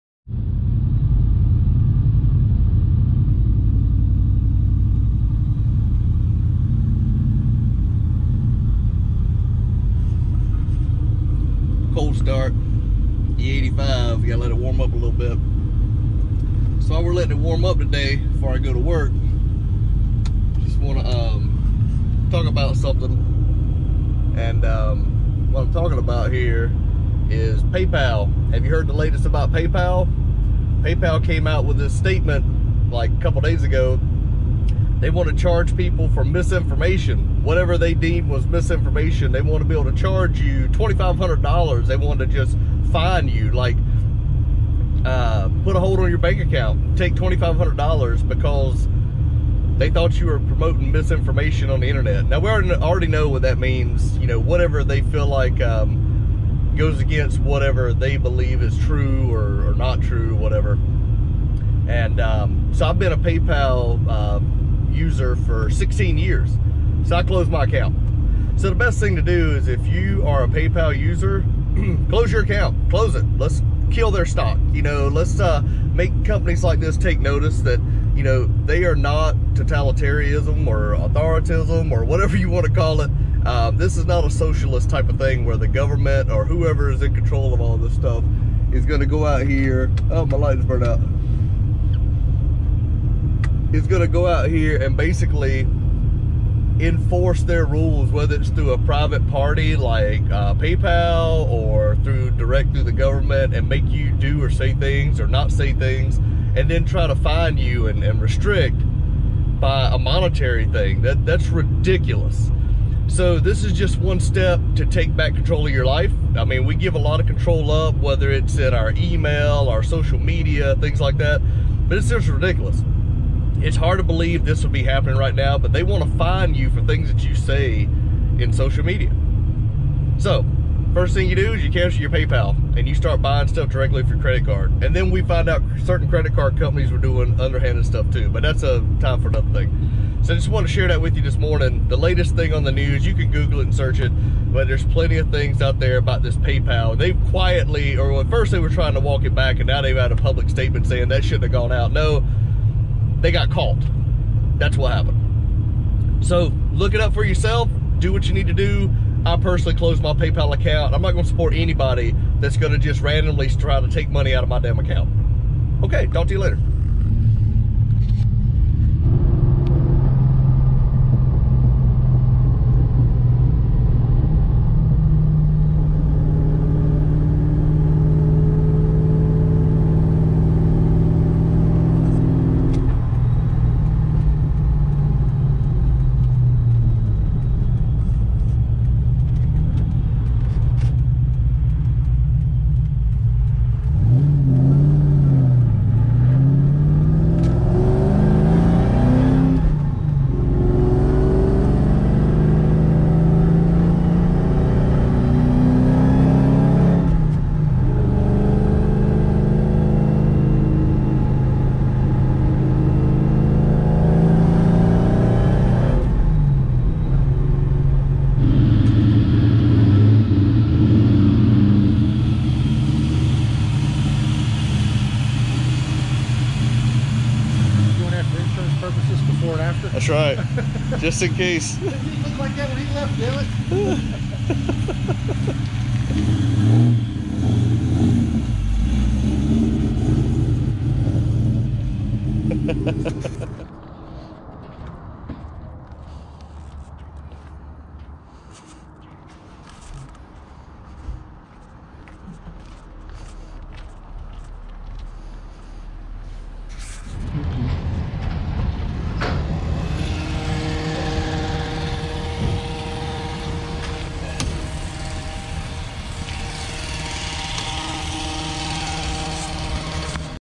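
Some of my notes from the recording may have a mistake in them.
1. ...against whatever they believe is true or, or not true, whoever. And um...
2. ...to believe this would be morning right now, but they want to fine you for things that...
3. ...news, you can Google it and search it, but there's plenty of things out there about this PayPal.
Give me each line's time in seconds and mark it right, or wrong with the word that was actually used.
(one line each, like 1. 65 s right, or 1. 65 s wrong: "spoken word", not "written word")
1. 56 s wrong: "whatever", not "whoever"
2. 123 s wrong: "happening", not "morning"
3. 142 s right.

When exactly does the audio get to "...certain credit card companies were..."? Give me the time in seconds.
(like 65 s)
135 s.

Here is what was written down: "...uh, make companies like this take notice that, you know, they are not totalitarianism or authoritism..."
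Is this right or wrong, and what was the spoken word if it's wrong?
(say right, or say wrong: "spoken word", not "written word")
right.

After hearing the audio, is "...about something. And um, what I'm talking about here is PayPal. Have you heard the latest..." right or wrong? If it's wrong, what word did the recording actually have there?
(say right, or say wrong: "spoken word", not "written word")
right.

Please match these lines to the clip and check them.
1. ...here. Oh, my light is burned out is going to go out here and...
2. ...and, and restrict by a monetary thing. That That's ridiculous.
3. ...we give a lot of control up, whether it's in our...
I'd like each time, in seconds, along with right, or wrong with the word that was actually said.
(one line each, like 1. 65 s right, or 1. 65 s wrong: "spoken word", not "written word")
1. 89 s right
2. 107 s right
3. 116 s right.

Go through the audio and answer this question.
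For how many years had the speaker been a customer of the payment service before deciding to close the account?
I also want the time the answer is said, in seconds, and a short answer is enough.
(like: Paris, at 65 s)
16 years, at 65 s.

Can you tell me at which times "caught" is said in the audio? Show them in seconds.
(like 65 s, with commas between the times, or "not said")
153 s.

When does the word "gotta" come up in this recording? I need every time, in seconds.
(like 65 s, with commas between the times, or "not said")
14 s.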